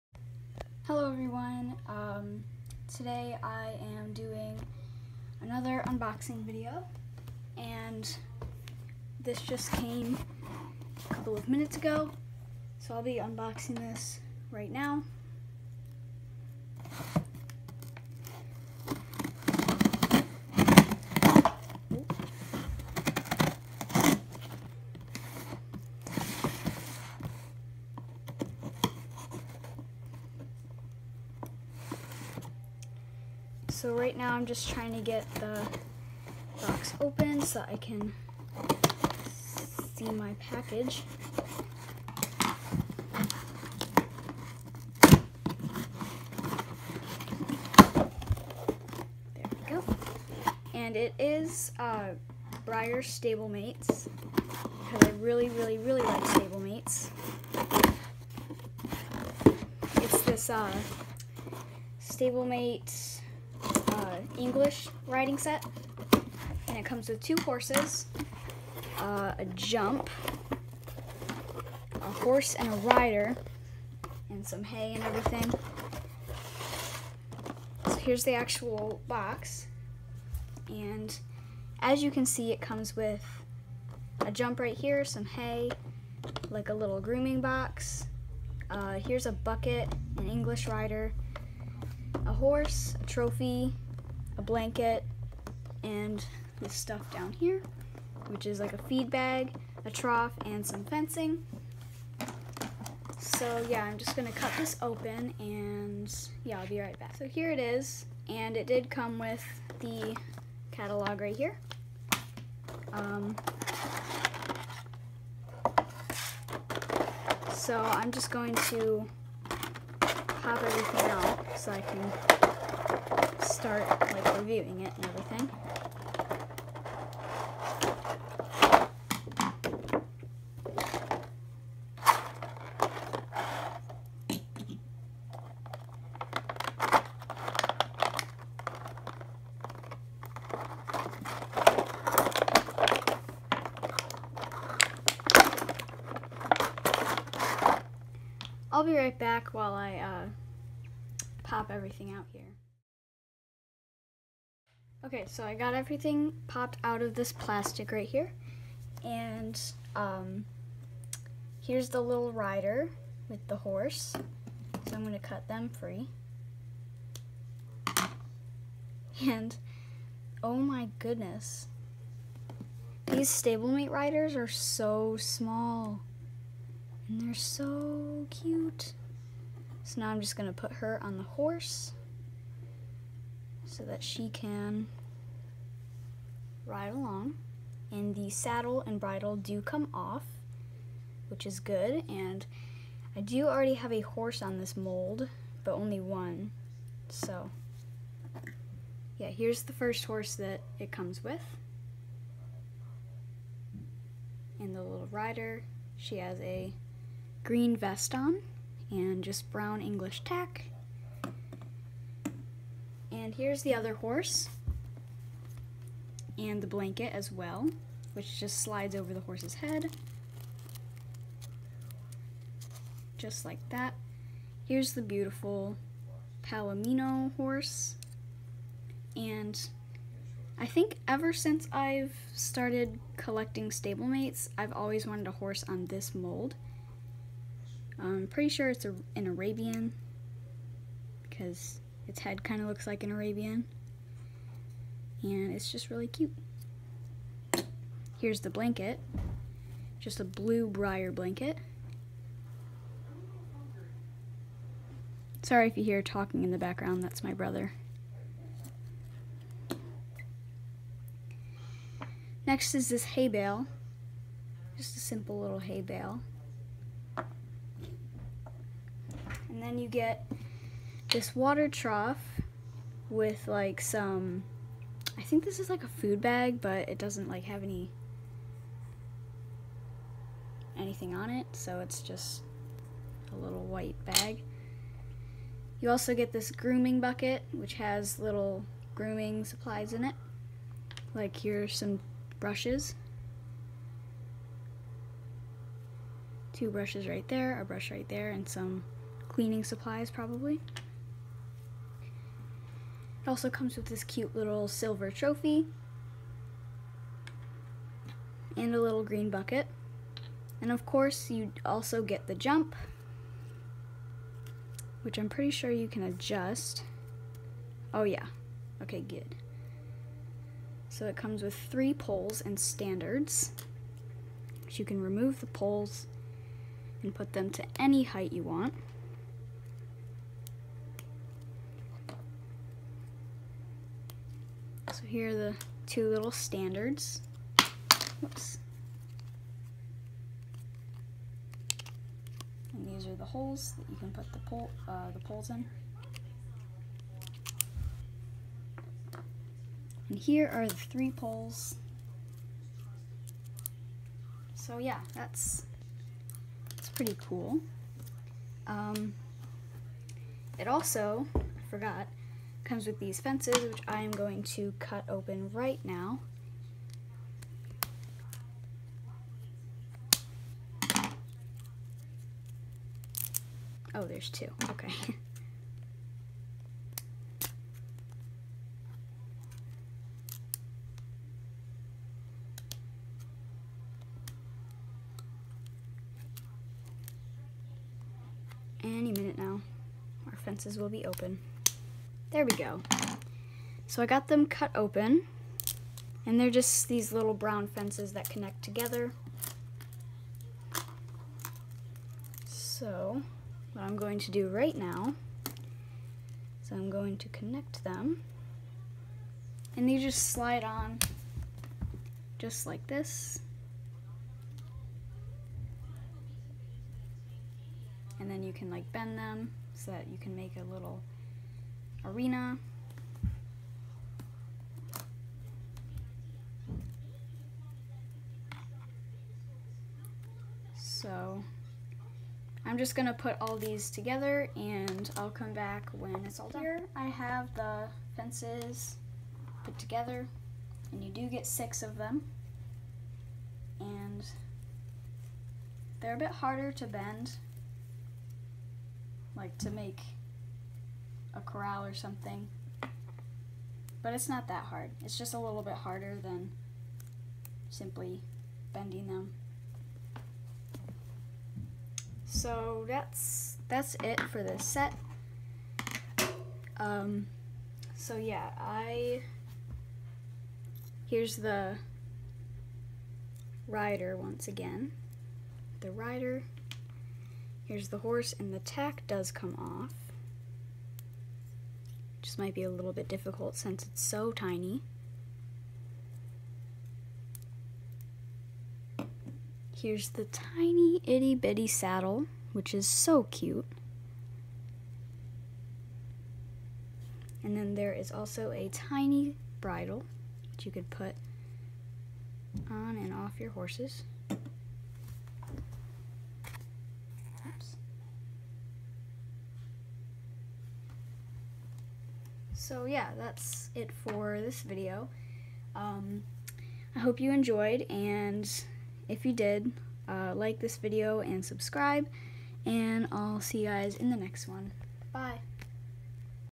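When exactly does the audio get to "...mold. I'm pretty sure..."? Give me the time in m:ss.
3:56.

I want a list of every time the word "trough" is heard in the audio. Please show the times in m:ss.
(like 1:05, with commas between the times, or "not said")
1:39, 4:31.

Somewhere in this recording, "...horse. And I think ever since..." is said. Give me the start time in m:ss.
3:47.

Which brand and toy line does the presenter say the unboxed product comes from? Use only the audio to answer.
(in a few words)
Breyer Stablemates.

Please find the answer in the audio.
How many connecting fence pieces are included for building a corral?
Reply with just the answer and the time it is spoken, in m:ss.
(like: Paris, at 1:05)
6, at 7:21.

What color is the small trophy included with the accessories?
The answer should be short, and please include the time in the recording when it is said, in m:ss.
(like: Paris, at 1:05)
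silver, at 5:04.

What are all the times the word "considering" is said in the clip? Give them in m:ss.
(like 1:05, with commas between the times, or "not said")
not said.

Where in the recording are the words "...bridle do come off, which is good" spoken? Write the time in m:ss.
3:08.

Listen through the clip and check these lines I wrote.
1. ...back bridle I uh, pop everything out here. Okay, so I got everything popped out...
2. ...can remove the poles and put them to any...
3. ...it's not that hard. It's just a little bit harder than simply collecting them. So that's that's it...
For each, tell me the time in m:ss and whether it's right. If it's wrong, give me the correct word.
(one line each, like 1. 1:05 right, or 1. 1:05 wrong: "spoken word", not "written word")
1. 2:29 wrong: "while", not "bridle"
2. 5:24 right
3. 7:34 wrong: "bending", not "collecting".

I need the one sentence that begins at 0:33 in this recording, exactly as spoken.
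So right now I'm just trying to get the box open so I can see my package.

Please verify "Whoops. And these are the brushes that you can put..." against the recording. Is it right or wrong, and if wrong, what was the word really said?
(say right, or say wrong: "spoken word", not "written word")
wrong: "holes", not "brushes".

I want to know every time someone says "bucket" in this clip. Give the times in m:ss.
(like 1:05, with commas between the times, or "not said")
1:29, 4:47, 5:09.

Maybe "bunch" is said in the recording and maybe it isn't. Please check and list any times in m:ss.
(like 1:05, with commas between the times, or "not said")
not said.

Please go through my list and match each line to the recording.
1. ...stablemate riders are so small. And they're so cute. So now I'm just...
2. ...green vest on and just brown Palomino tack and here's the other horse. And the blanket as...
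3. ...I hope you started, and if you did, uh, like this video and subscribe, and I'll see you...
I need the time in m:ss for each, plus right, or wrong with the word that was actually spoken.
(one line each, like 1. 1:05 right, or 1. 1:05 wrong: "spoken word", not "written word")
1. 2:53 right
2. 3:27 wrong: "English", not "Palomino"
3. 8:36 wrong: "enjoyed", not "started".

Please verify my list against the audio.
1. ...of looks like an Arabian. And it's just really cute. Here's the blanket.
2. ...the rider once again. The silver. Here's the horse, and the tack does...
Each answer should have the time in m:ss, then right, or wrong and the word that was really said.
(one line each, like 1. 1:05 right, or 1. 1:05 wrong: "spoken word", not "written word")
1. 4:02 right
2. 7:51 wrong: "rider", not "silver".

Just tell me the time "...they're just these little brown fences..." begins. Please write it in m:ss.
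6:36.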